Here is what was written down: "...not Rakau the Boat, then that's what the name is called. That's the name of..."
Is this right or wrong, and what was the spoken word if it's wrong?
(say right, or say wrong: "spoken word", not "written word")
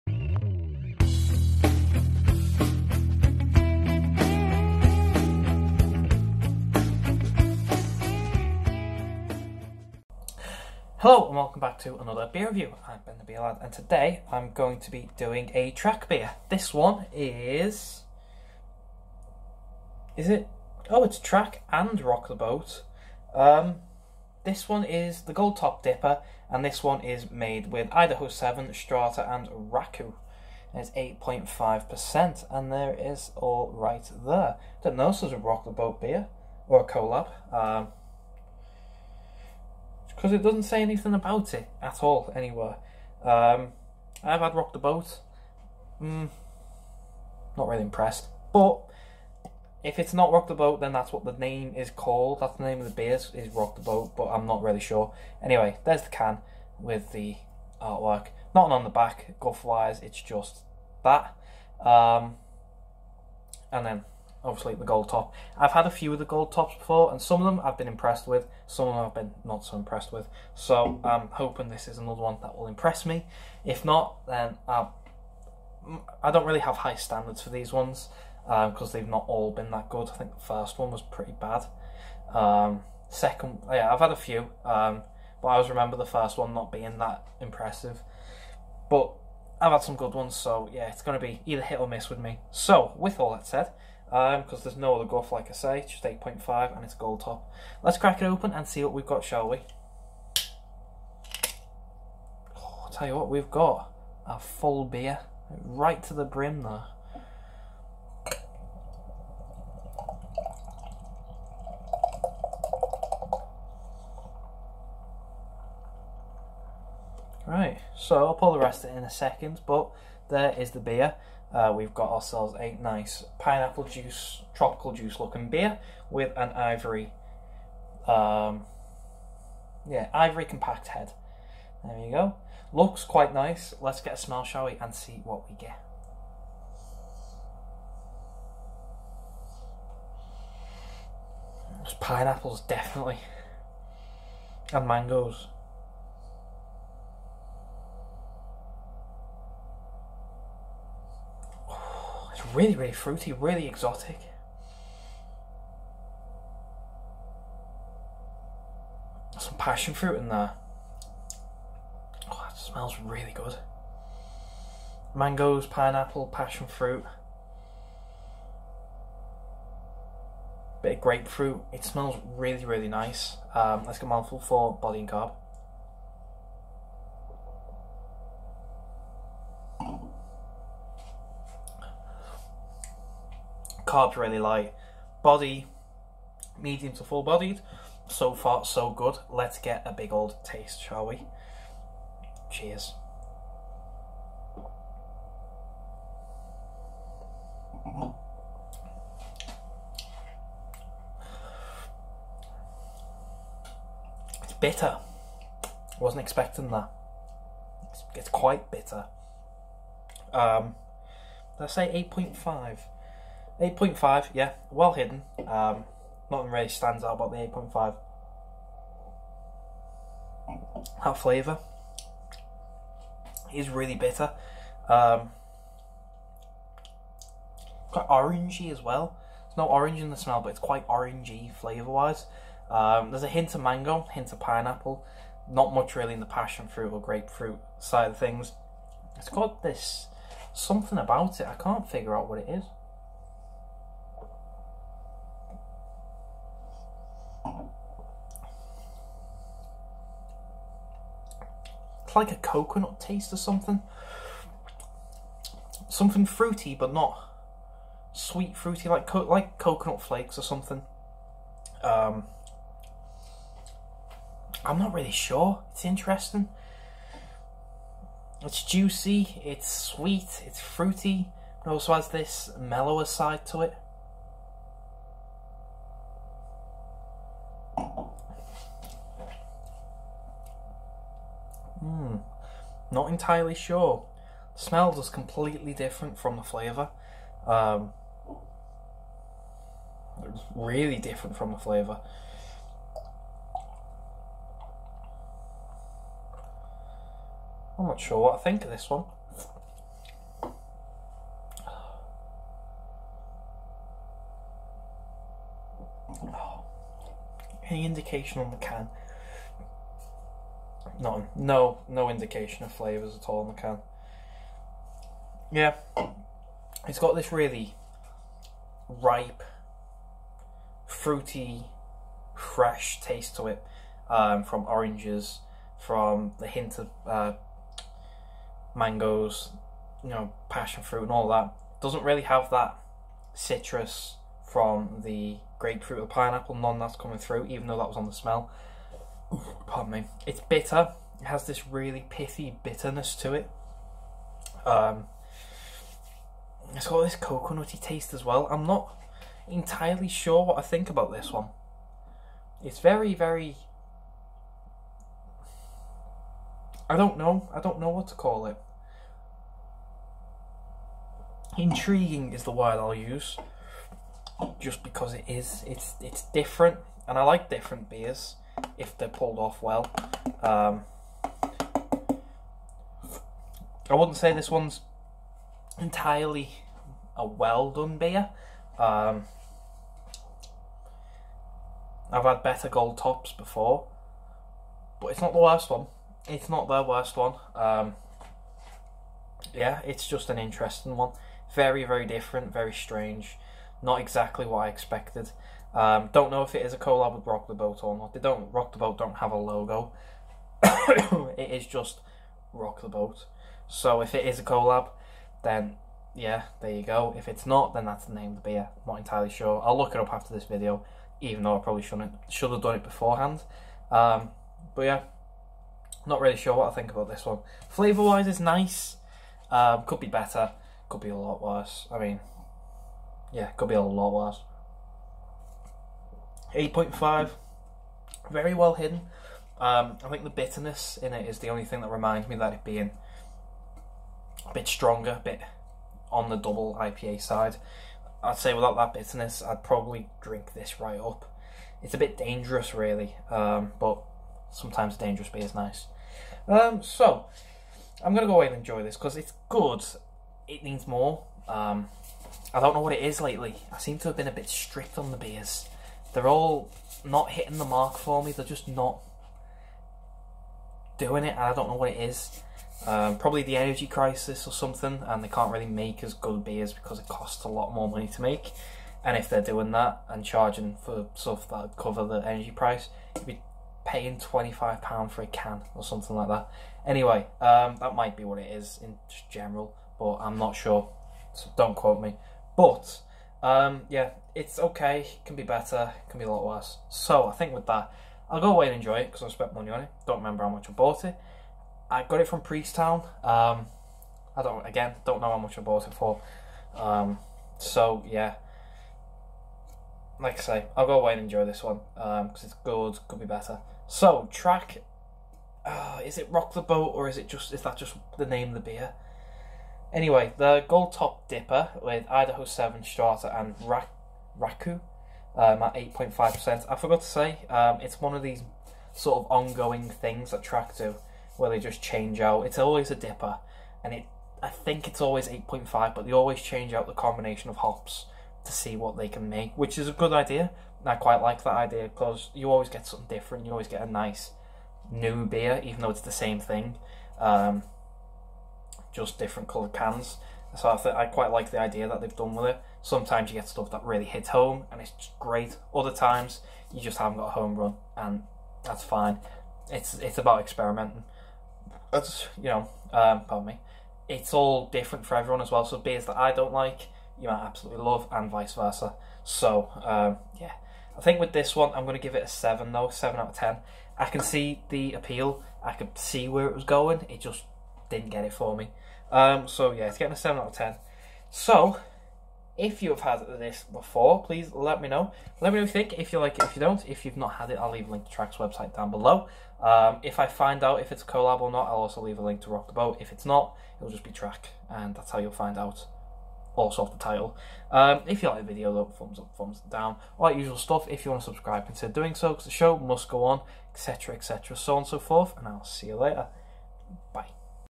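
wrong: "Rock", not "Rakau".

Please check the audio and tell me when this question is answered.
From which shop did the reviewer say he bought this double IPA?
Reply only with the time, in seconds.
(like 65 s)
492 s.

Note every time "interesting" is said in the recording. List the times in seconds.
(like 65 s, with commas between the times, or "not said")
265 s, 390 s.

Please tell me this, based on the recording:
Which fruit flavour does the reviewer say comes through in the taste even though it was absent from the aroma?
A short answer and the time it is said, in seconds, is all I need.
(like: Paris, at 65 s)
Orange, at 230 s.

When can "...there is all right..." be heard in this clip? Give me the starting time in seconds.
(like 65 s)
32 s.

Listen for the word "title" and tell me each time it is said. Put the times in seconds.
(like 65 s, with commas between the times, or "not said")
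587 s.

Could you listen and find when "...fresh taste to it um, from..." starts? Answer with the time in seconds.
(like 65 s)
322 s.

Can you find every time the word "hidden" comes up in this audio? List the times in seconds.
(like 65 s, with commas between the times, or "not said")
214 s, 428 s.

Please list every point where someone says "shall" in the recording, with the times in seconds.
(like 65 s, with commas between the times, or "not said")
99 s, 134 s, 190 s.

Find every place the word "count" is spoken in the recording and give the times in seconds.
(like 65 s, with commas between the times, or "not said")
not said.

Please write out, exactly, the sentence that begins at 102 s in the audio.
Oh, tell you what, we've got a full beer right to the brim there.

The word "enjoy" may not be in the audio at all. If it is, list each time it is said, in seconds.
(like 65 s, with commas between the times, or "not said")
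448 s, 488 s, 501 s.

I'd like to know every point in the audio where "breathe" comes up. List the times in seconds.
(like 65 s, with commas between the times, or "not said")
not said.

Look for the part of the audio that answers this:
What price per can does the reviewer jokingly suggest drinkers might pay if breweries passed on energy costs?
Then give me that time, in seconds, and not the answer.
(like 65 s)
474 s.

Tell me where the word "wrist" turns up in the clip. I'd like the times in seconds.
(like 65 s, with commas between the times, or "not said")
not said.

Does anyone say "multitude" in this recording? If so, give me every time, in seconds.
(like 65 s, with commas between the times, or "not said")
not said.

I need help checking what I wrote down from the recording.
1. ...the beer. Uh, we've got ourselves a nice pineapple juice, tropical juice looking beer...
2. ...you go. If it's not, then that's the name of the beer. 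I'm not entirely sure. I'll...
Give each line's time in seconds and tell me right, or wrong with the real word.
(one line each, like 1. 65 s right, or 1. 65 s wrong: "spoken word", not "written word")
1. 120 s right
2. 406 s right.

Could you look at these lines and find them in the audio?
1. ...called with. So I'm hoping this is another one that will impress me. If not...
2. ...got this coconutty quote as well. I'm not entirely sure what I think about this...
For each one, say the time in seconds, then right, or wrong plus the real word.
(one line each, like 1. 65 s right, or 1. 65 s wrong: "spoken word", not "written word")
1. 69 s wrong: "impressed", not "called"
2. 346 s wrong: "taste", not "quote".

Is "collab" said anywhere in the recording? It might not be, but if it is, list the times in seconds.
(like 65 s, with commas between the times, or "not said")
36 s, 396 s, 404 s, 581 s.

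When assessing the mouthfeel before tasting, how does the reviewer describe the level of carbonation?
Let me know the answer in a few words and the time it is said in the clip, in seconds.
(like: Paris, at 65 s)
Really light, at 183 s.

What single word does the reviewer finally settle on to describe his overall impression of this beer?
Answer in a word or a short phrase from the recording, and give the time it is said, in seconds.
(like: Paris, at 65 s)
Intriguing, at 361 s.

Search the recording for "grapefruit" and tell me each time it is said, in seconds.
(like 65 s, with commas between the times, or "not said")
171 s, 237 s, 335 s.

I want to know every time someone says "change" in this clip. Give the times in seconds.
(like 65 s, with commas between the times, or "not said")
521 s, 526 s.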